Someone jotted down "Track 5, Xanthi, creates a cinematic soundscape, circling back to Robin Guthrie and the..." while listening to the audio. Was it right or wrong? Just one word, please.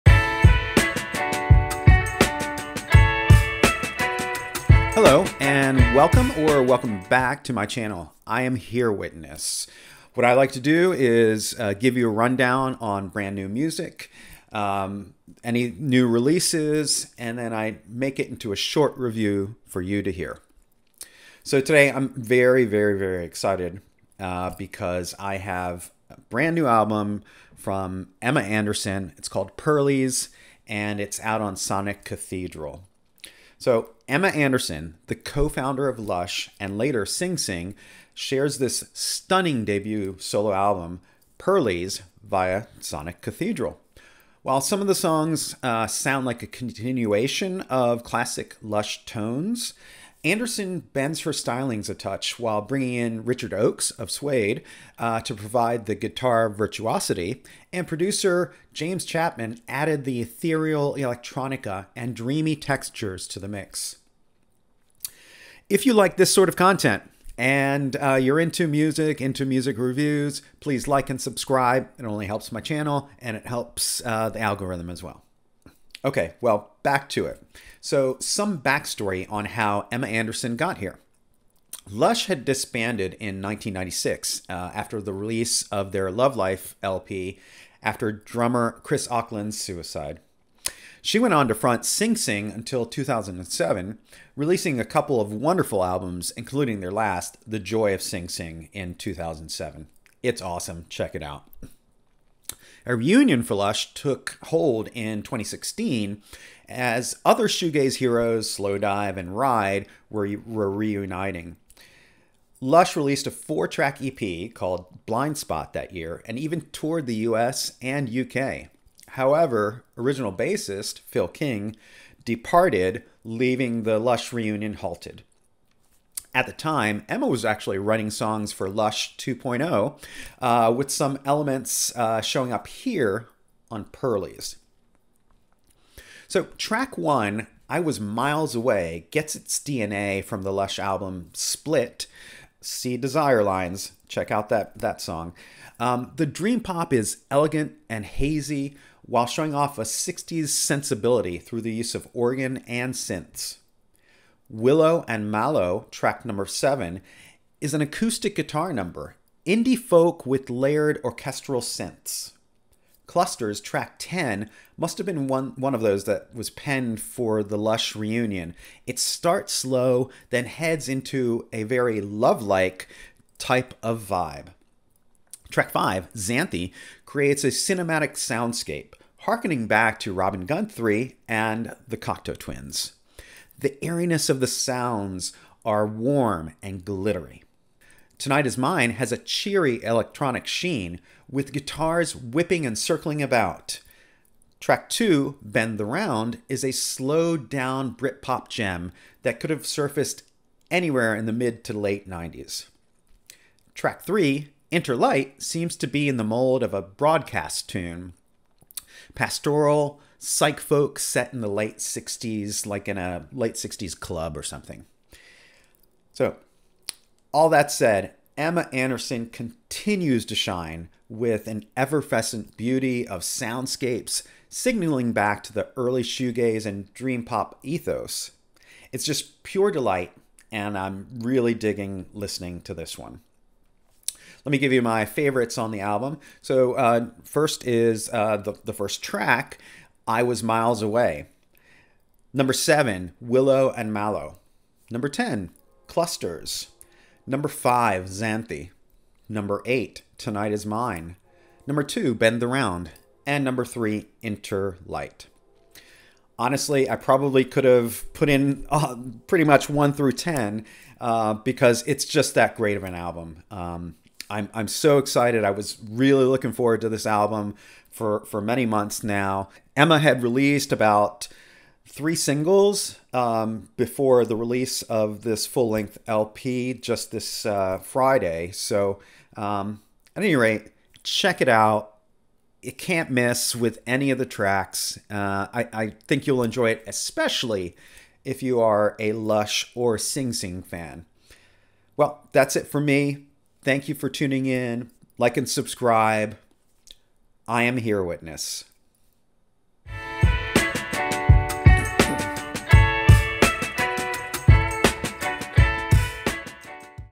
wrong.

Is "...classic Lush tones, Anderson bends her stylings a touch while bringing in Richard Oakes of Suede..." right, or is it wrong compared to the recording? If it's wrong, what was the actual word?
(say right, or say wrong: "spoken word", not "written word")
right.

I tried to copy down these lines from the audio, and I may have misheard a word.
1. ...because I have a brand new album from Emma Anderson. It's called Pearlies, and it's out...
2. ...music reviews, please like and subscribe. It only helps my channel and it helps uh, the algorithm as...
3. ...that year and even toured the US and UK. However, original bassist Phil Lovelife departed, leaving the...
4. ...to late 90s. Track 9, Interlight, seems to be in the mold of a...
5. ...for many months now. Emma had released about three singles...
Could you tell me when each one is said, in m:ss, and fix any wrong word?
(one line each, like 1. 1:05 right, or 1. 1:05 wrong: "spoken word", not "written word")
1. 0:24 right
2. 1:09 right
3. 1:55 wrong: "King", not "Lovelife"
4. 3:21 wrong: "3", not "9"
5. 4:28 right.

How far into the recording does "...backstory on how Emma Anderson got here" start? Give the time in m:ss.
1:18.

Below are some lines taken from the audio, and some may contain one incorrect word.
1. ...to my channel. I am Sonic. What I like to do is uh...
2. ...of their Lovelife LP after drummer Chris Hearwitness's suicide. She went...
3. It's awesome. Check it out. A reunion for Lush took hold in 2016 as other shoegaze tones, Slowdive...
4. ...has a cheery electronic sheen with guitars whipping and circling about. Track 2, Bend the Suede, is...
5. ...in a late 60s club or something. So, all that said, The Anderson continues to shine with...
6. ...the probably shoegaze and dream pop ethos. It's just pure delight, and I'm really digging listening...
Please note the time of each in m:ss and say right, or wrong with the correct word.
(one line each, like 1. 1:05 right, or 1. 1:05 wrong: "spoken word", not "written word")
1. 0:07 wrong: "Hearwitness", not "Sonic"
2. 1:25 wrong: "Acland", not "Hearwitness"
3. 1:40 wrong: "heroes", not "tones"
4. 3:08 wrong: "Round", not "Suede"
5. 3:32 wrong: "Emma", not "The"
6. 3:45 wrong: "early", not "probably".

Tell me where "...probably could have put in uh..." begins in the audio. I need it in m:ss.
4:16.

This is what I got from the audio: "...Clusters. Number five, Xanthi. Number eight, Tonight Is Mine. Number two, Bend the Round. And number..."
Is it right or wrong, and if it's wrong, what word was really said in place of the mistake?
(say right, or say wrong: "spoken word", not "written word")
right.